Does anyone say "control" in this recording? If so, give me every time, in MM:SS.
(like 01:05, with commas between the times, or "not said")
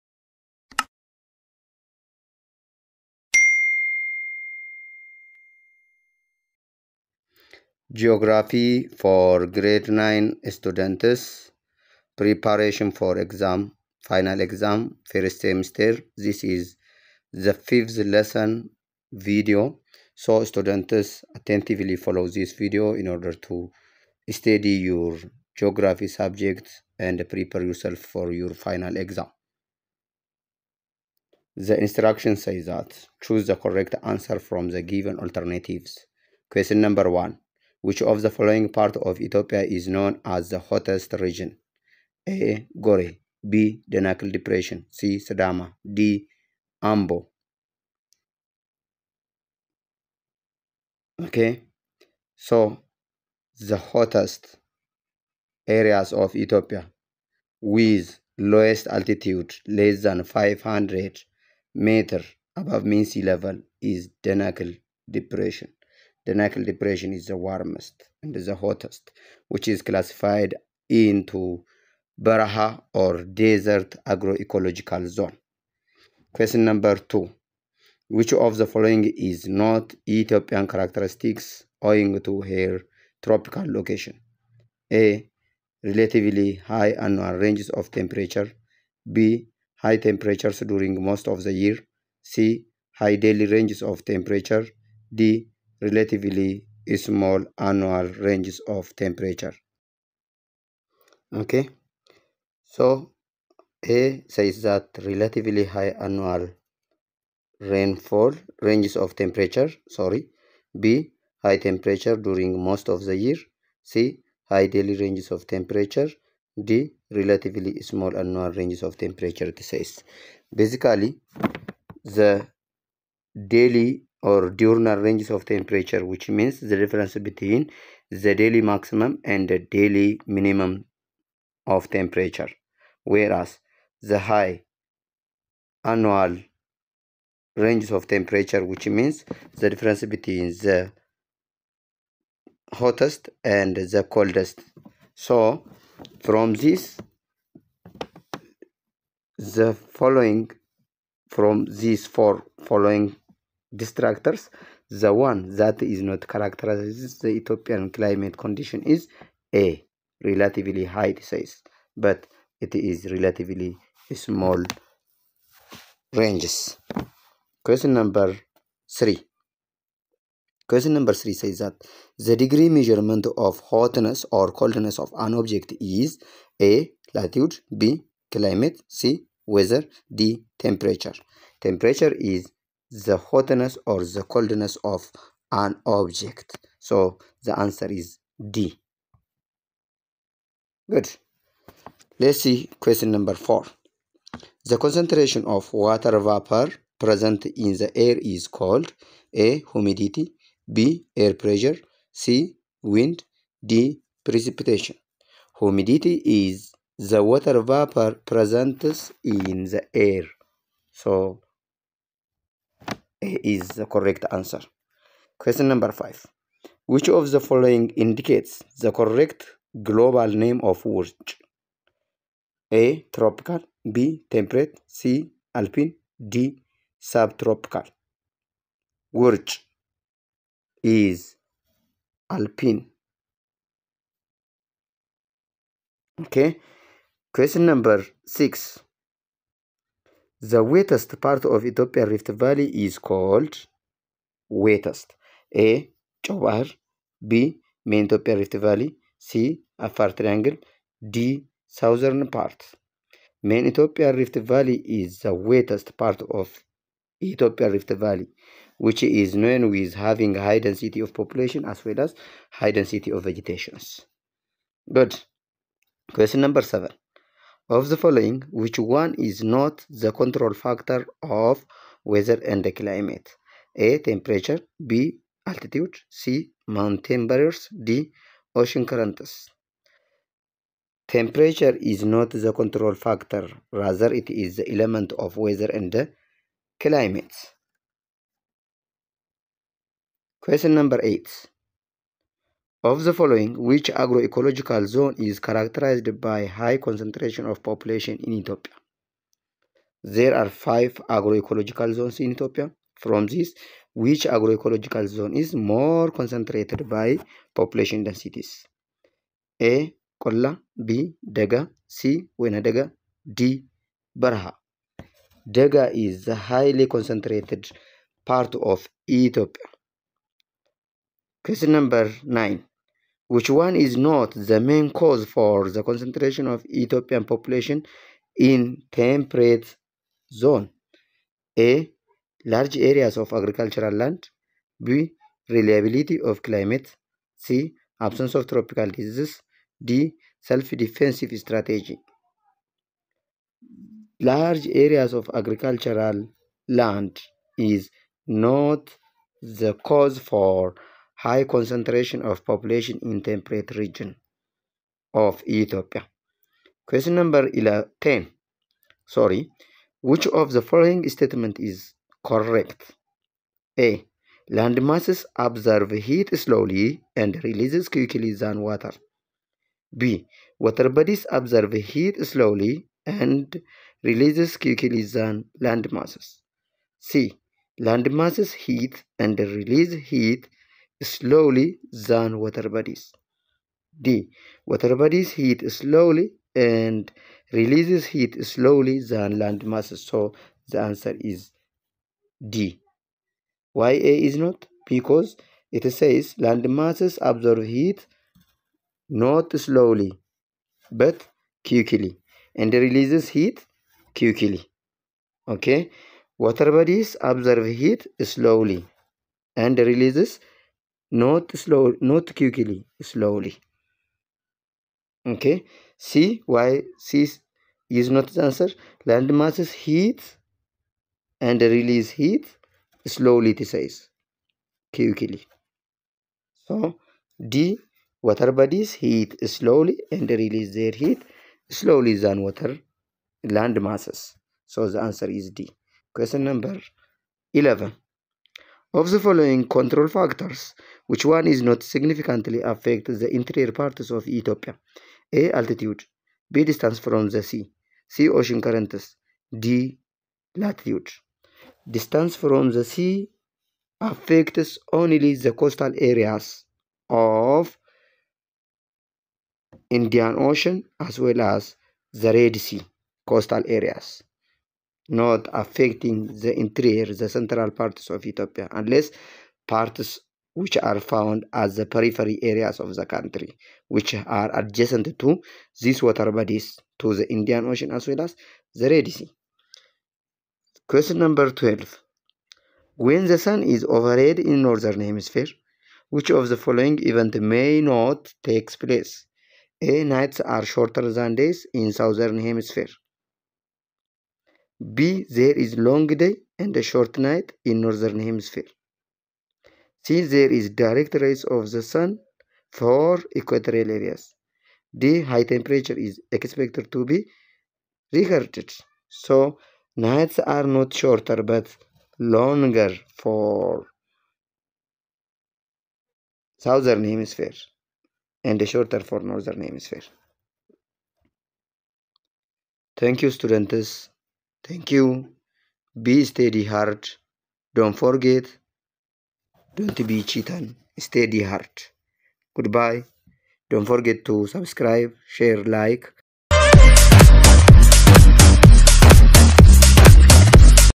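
04:30, 04:42, 07:19.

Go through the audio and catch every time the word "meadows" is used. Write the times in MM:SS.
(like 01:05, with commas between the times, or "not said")
not said.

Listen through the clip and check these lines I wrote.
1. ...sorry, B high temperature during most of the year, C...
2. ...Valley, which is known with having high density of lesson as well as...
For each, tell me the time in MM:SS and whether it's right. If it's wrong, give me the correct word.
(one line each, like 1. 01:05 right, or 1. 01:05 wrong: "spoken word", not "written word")
1. 01:49 right
2. 04:17 wrong: "population", not "lesson".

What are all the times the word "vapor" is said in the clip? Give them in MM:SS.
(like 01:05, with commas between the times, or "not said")
03:16, 03:27.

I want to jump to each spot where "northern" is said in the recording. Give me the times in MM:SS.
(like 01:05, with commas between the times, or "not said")
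08:04, 08:17, 08:39.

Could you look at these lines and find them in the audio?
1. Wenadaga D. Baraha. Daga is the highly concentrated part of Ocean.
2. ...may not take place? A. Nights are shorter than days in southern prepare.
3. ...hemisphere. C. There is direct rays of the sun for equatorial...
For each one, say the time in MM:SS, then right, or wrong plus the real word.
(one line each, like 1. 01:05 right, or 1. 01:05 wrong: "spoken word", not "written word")
1. 05:12 wrong: "Ethiopia", not "Ocean"
2. 08:07 wrong: "hemisphere", not "prepare"
3. 08:18 right.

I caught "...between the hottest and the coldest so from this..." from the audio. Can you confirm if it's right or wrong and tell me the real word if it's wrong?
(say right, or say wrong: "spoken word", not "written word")
right.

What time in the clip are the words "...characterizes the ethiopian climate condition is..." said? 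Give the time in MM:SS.
02:36.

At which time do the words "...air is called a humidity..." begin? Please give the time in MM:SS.
03:17.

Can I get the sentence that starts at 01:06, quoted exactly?
The Nile Depression is the warmest and the hottest, which is classified into Baraha or desert agroecological zone.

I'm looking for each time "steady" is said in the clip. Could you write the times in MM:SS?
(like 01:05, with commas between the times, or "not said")
08:46, 08:50.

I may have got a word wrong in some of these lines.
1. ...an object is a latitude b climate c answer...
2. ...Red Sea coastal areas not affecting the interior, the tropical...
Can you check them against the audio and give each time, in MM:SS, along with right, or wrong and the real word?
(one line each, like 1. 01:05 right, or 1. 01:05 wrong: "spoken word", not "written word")
1. 02:55 wrong: "weather", not "answer"
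2. 07:42 wrong: "central", not "tropical".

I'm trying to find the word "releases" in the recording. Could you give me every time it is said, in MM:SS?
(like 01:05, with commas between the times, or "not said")
06:07, 06:14, 06:19, 06:27, 06:42, 06:49, 07:01, 07:10.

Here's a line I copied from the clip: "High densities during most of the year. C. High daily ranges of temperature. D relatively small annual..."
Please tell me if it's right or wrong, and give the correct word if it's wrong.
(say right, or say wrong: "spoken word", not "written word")
wrong: "temperatures", not "densities".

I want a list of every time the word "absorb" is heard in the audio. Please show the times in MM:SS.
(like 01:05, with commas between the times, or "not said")
06:05, 06:11, 06:37, 06:47.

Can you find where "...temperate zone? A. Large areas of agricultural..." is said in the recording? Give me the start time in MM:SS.
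05:28.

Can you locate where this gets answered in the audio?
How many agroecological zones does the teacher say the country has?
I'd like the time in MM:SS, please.
05:00.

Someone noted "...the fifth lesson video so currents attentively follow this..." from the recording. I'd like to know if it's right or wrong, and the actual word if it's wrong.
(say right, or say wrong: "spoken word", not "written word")
wrong: "students", not "currents".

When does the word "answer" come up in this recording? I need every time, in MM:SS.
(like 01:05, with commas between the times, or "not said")
00:34, 03:07, 03:34, 06:30, 06:58, 07:15.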